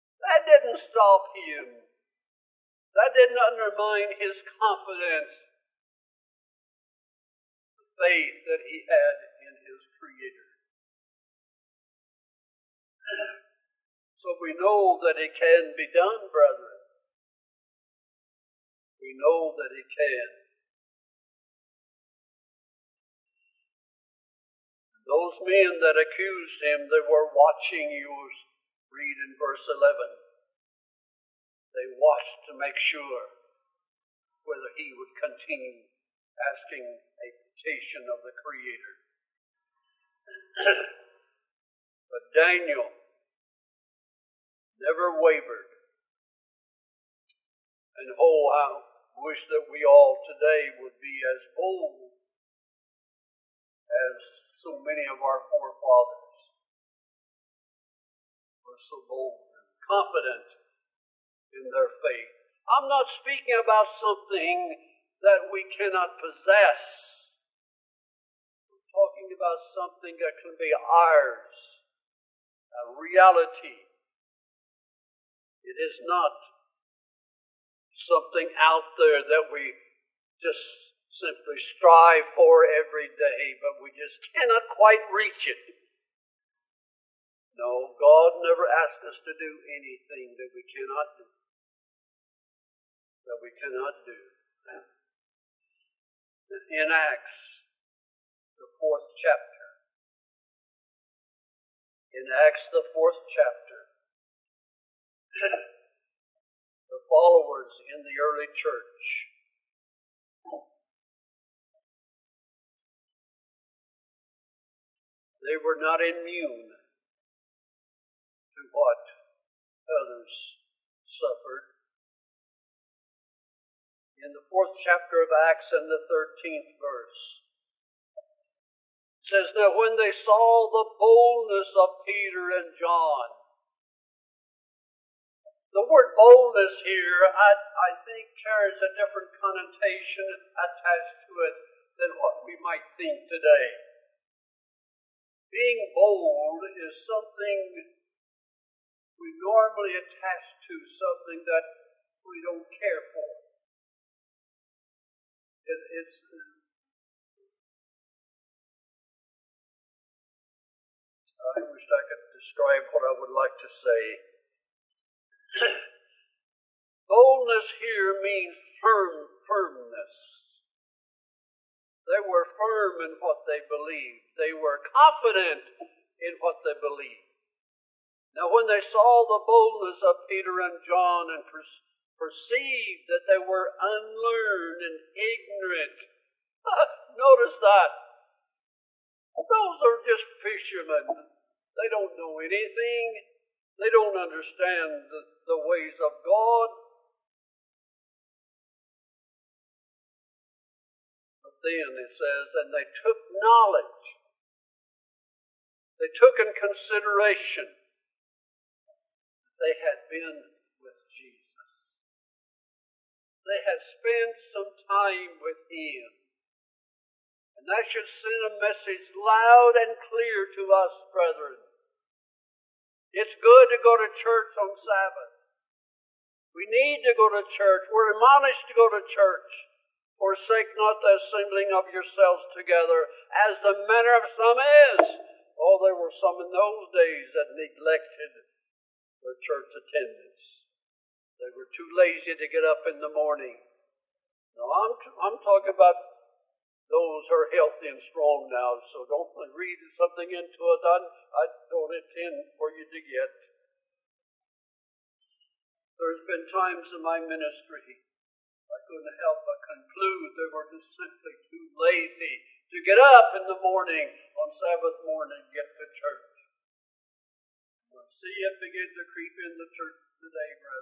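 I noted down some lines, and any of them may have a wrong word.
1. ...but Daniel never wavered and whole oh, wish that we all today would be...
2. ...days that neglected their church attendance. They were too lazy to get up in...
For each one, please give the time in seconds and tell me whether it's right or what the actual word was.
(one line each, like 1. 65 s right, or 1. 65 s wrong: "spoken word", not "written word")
1. 42 s right
2. 236 s right.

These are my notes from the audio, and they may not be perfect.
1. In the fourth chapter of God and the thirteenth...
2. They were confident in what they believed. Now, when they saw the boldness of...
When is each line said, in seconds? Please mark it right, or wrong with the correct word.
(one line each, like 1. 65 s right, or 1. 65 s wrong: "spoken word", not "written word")
1. 124 s wrong: "Acts", not "God"
2. 174 s right.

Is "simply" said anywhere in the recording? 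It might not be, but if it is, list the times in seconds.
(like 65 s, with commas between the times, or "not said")
81 s, 260 s.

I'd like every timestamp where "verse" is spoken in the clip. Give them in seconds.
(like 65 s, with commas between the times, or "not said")
29 s, 126 s.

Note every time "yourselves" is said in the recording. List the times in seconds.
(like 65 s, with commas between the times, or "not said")
231 s.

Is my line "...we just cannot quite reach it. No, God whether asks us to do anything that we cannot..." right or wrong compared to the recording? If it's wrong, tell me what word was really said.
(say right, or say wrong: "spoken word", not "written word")
wrong: "never", not "whether".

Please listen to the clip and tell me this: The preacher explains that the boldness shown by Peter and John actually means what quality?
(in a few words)
firmness.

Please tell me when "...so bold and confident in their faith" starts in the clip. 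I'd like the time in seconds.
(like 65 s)
58 s.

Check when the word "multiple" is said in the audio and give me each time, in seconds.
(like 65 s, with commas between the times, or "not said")
not said.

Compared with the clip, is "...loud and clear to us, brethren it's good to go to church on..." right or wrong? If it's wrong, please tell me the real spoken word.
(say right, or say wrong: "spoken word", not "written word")
right.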